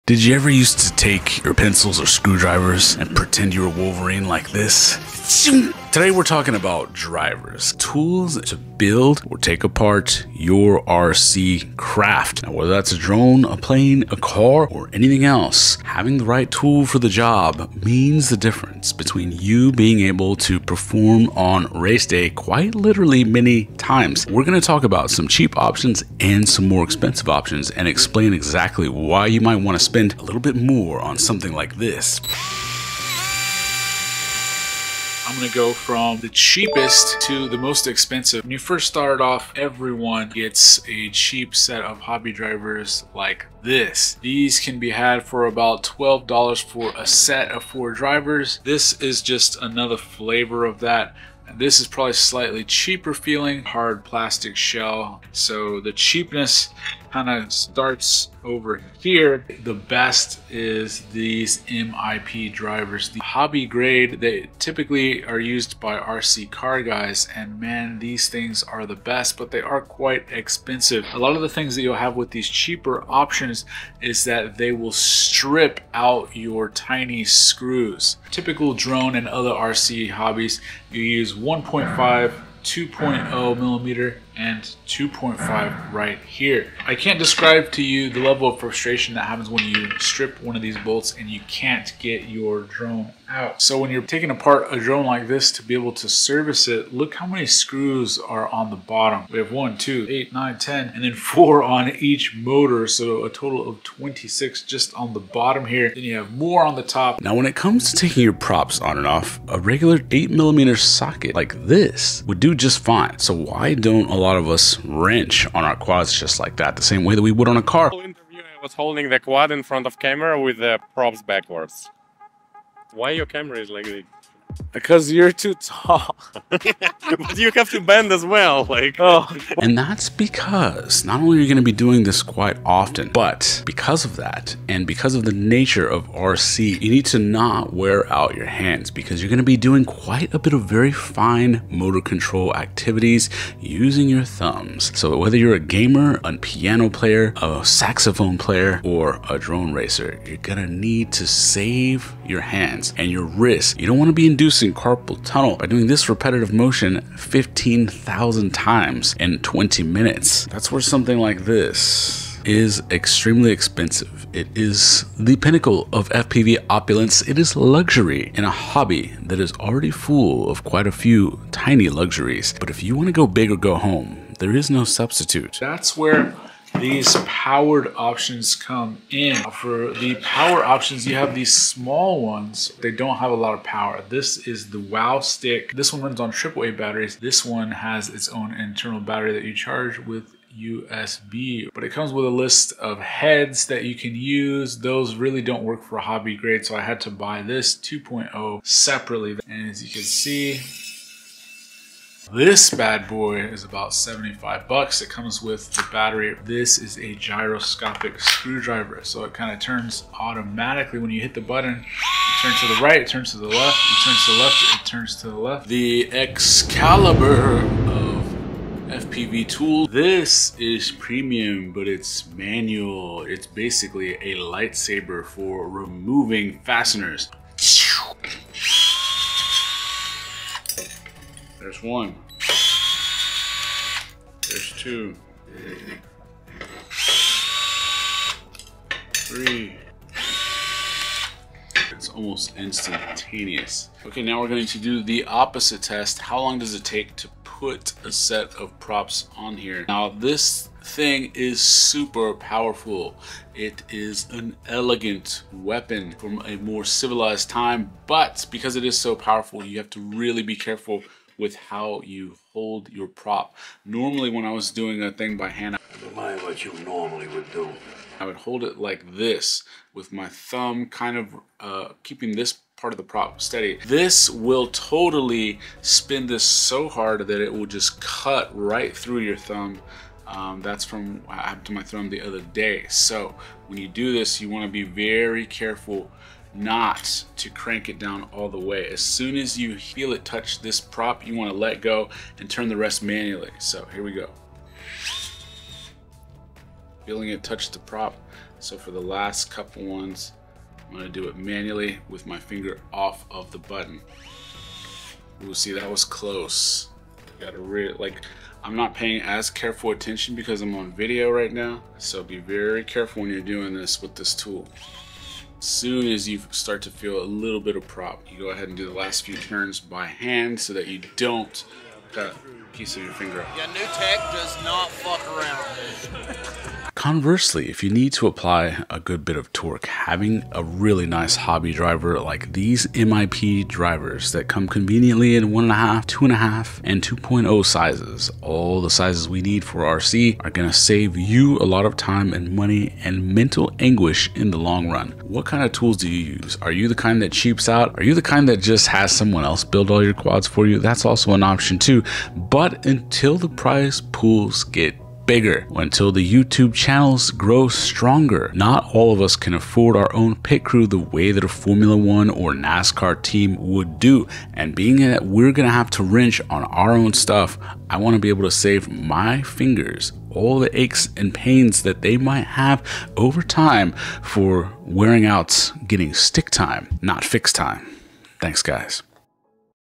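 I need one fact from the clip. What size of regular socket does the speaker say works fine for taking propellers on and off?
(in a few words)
8 millimeter.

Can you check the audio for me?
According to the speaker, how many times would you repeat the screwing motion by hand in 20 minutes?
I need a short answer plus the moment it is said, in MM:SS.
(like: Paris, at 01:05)
15,000, at 02:37.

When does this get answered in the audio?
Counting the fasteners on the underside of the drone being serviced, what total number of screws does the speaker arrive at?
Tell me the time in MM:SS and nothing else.
01:43.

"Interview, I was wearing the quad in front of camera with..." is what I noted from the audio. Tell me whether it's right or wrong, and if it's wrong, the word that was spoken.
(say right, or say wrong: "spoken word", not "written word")
wrong: "holding", not "wearing".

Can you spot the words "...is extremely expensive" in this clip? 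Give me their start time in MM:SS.
02:42.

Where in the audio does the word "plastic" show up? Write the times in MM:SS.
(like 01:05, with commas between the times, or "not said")
00:54.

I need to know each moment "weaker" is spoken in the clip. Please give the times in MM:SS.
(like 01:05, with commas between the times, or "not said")
not said.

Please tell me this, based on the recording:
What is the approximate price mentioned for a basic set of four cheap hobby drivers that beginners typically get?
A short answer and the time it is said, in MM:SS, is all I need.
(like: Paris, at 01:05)
$12, at 00:45.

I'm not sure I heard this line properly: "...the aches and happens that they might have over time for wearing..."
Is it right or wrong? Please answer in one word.
wrong.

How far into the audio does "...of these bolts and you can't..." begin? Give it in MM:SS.
01:30.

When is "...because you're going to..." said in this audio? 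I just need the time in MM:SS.
02:18.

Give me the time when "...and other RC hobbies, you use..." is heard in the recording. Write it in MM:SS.
01:19.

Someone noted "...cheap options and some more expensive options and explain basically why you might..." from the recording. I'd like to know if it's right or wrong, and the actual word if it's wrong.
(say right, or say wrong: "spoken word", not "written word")
wrong: "exactly", not "basically".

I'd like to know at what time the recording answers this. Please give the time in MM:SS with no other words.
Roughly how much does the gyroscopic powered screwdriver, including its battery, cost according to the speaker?
03:23.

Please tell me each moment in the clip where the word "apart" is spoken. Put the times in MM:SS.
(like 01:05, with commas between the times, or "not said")
00:09, 01:34.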